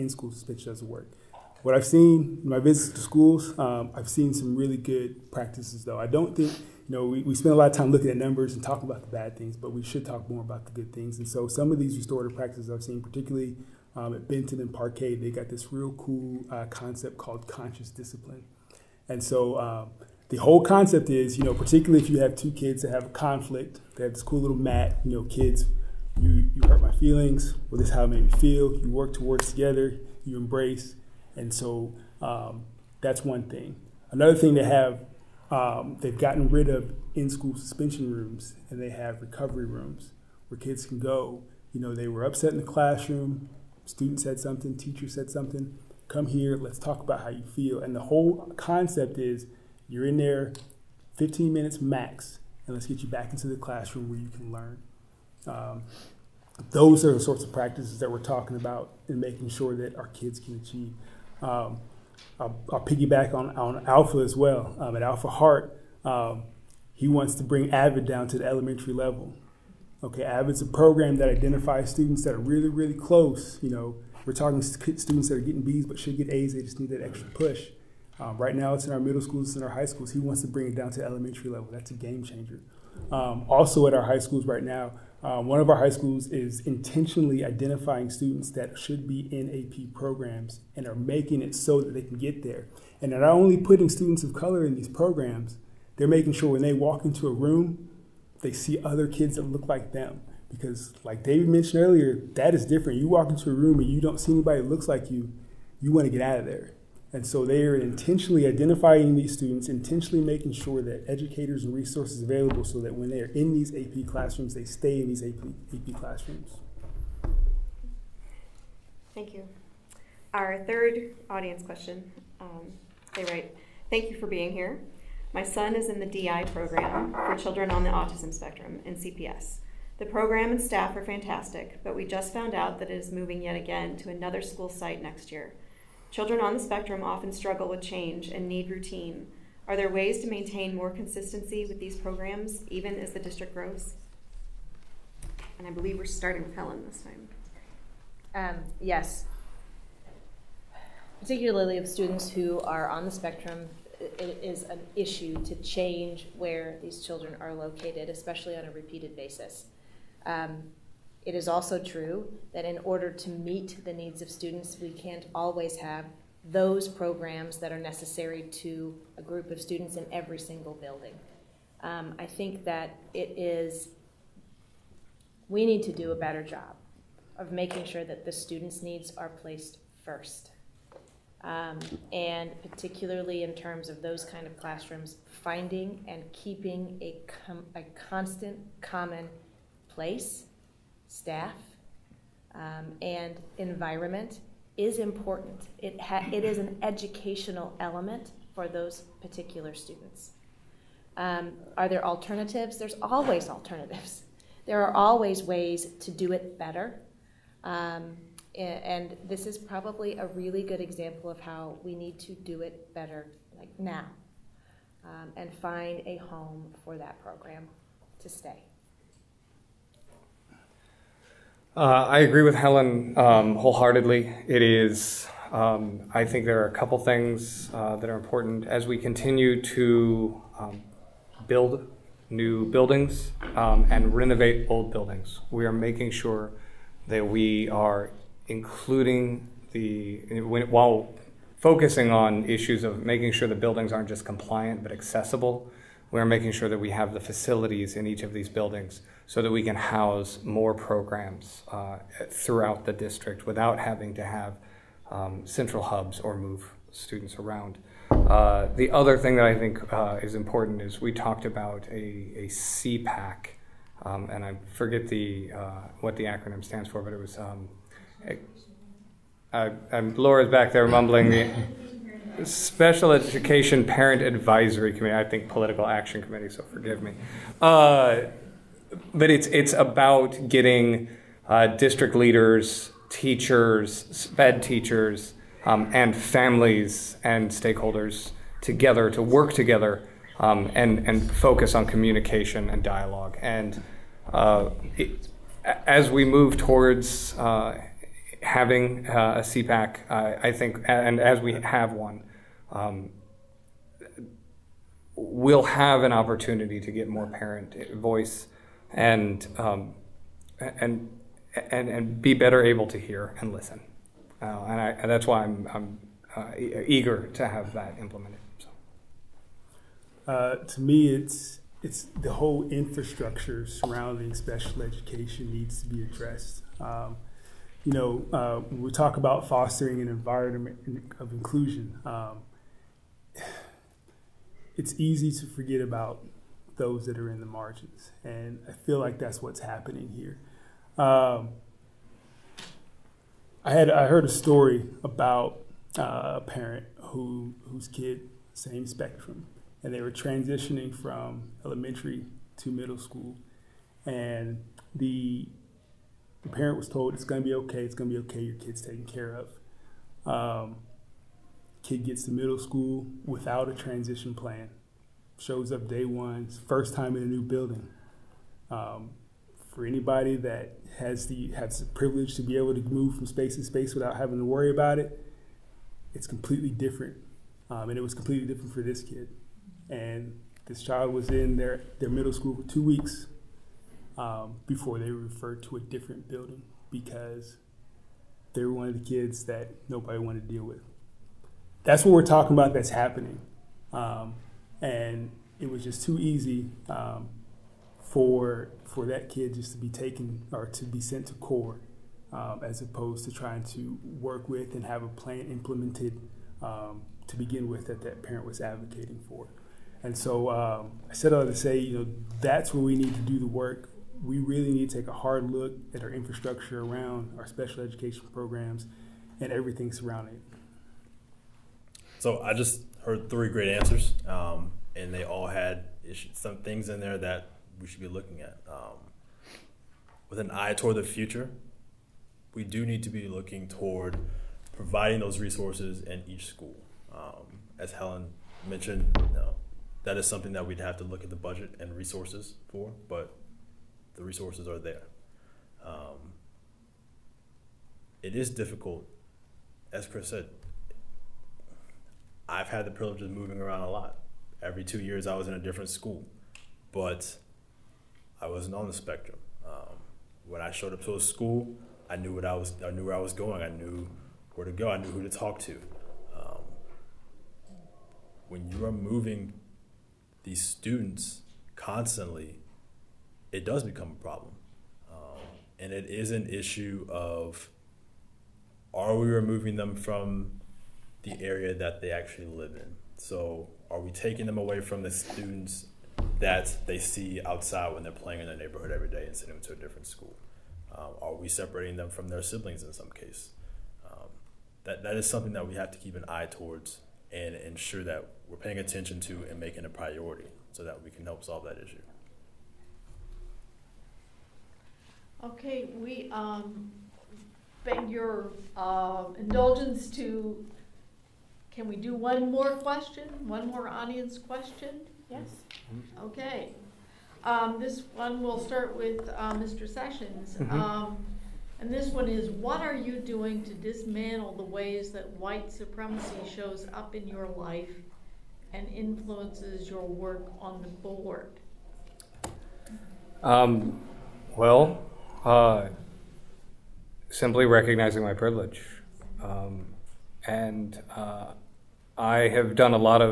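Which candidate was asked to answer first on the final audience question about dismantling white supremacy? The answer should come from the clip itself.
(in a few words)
Mr. Sessions.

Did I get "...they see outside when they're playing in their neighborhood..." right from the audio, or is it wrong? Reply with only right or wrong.
right.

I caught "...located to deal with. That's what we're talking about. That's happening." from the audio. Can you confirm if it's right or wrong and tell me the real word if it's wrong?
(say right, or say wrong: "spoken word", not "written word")
wrong: "wanted", not "located".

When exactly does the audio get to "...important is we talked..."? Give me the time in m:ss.
4:20.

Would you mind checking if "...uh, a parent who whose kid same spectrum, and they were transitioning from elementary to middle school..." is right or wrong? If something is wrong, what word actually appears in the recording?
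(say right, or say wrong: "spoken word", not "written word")
right.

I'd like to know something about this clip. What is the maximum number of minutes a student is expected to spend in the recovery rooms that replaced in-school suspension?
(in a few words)
15 minutes.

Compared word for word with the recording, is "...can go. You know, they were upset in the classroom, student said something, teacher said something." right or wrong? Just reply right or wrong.
right.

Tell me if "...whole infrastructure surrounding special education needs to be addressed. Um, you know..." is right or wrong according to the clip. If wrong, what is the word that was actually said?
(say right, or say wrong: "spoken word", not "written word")
right.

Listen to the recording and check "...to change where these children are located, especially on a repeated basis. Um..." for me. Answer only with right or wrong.
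right.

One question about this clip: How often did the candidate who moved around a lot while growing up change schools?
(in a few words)
every 2 years.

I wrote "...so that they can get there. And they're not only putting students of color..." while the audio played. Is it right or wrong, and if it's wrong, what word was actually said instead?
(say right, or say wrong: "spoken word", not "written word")
right.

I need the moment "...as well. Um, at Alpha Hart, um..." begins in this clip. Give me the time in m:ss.
1:04.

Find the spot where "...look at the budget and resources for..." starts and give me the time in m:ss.
7:21.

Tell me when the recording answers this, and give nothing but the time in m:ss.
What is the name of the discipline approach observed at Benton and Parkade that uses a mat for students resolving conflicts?
0:17.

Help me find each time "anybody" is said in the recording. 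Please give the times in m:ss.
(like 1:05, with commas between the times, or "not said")
1:44, 6:09.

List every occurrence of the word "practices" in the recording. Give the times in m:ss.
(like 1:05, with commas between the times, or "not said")
0:05, 0:12, 0:57.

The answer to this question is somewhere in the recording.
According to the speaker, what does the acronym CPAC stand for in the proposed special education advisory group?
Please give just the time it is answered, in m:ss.
4:32.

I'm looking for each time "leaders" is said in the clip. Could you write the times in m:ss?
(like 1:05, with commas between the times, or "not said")
4:42.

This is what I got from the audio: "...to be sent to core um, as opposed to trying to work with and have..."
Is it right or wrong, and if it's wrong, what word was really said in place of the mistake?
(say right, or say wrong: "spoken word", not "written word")
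right.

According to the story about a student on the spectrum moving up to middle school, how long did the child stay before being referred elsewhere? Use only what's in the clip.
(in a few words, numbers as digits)
2 weeks.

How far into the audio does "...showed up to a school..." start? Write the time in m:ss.
7:40.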